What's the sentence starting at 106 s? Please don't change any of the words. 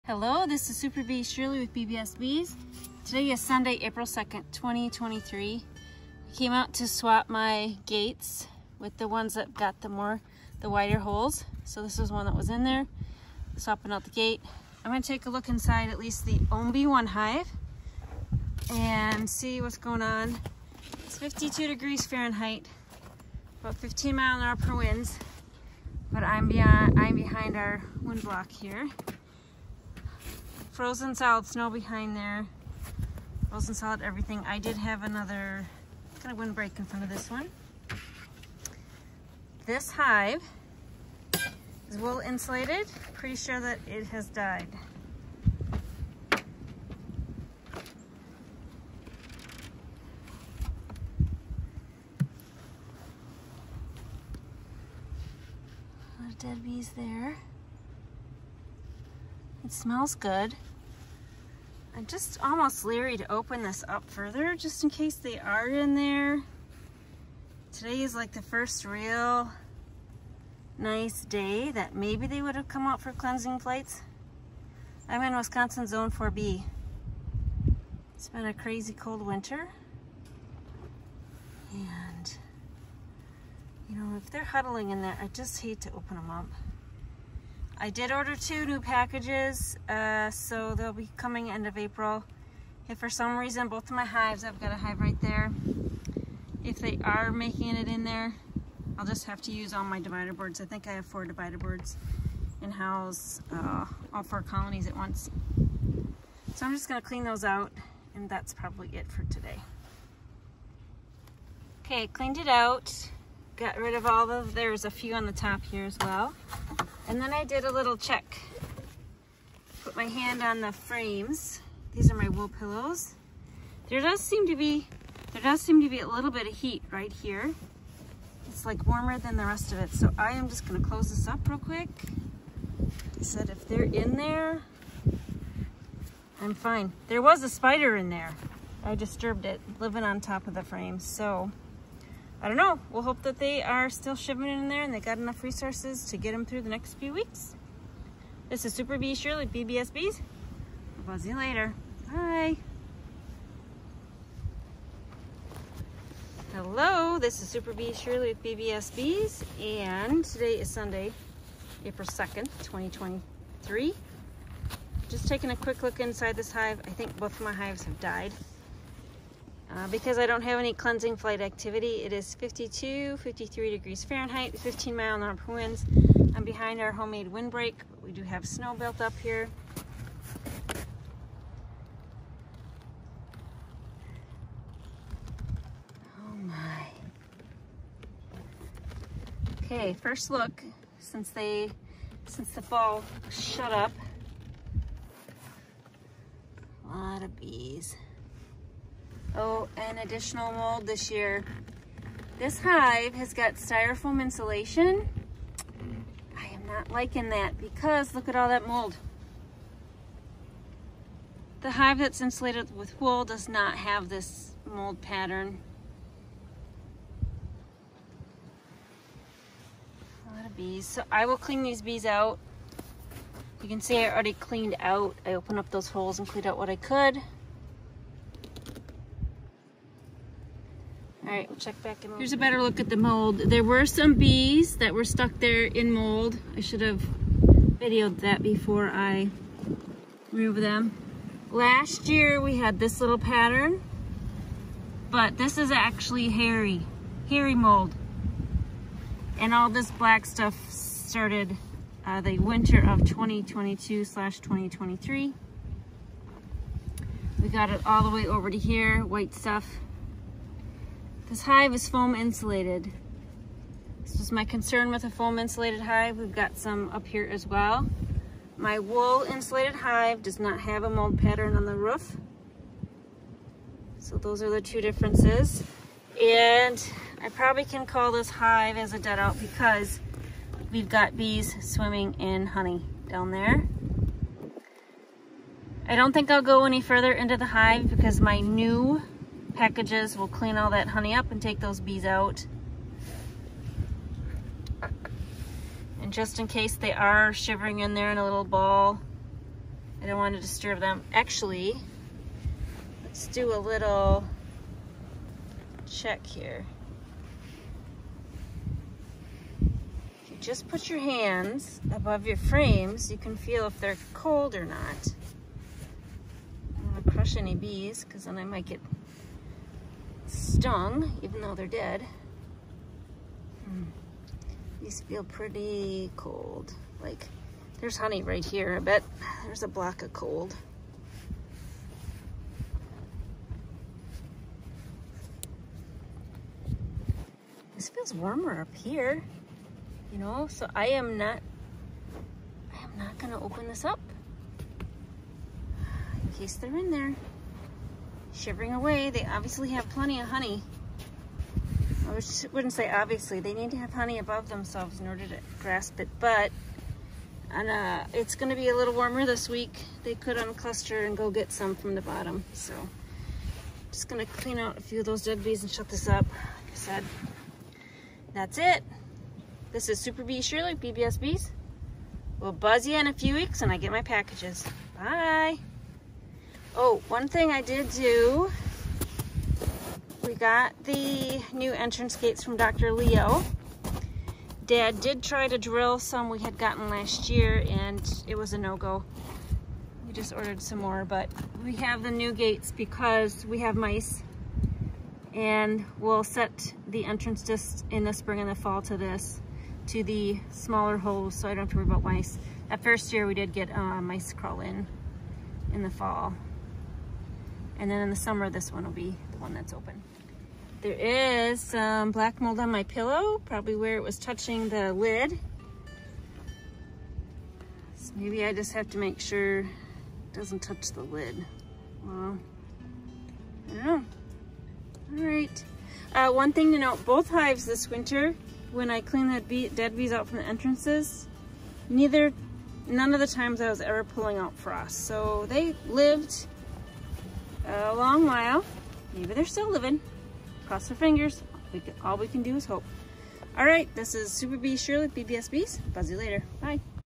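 So I'm just gonna clean those out and that's probably it for today.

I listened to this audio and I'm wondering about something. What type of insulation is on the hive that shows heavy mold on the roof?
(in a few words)
Styrofoam.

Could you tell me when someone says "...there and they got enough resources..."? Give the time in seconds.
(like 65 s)
144 s.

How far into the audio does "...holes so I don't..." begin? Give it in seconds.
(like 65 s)
400 s.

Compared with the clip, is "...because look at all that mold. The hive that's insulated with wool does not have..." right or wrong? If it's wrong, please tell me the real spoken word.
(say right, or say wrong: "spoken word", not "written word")
right.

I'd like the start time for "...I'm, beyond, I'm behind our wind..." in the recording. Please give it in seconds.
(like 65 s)
26 s.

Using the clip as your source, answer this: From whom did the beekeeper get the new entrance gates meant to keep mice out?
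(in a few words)
Dr. Leo.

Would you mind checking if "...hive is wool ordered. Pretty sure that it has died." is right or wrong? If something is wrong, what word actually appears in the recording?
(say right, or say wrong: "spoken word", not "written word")
wrong: "insulated", not "ordered".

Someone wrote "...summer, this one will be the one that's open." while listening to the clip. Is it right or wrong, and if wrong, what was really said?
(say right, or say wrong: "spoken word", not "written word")
right.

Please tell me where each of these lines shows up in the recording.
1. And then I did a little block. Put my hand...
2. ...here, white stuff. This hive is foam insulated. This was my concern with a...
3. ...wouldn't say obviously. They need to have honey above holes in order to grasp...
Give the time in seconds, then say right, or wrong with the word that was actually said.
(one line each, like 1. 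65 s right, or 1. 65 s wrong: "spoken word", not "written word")
1. 117 s wrong: "check", not "block"
2. 258 s right
3. 352 s wrong: "themselves", not "holes".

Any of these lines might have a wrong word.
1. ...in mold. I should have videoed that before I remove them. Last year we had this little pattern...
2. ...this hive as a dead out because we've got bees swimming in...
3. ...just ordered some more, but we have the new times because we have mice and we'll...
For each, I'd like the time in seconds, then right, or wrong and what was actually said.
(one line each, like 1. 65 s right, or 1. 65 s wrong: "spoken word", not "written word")
1. 235 s right
2. 278 s right
3. 390 s wrong: "gates", not "times".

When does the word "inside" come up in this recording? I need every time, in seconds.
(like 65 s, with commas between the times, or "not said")
15 s, 165 s.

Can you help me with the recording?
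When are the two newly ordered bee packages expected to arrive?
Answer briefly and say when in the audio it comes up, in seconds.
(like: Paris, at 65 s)
End of April, at 91 s.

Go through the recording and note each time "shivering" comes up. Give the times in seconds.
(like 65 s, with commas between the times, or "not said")
297 s, 348 s.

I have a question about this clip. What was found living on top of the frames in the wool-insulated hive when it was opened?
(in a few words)
A spider.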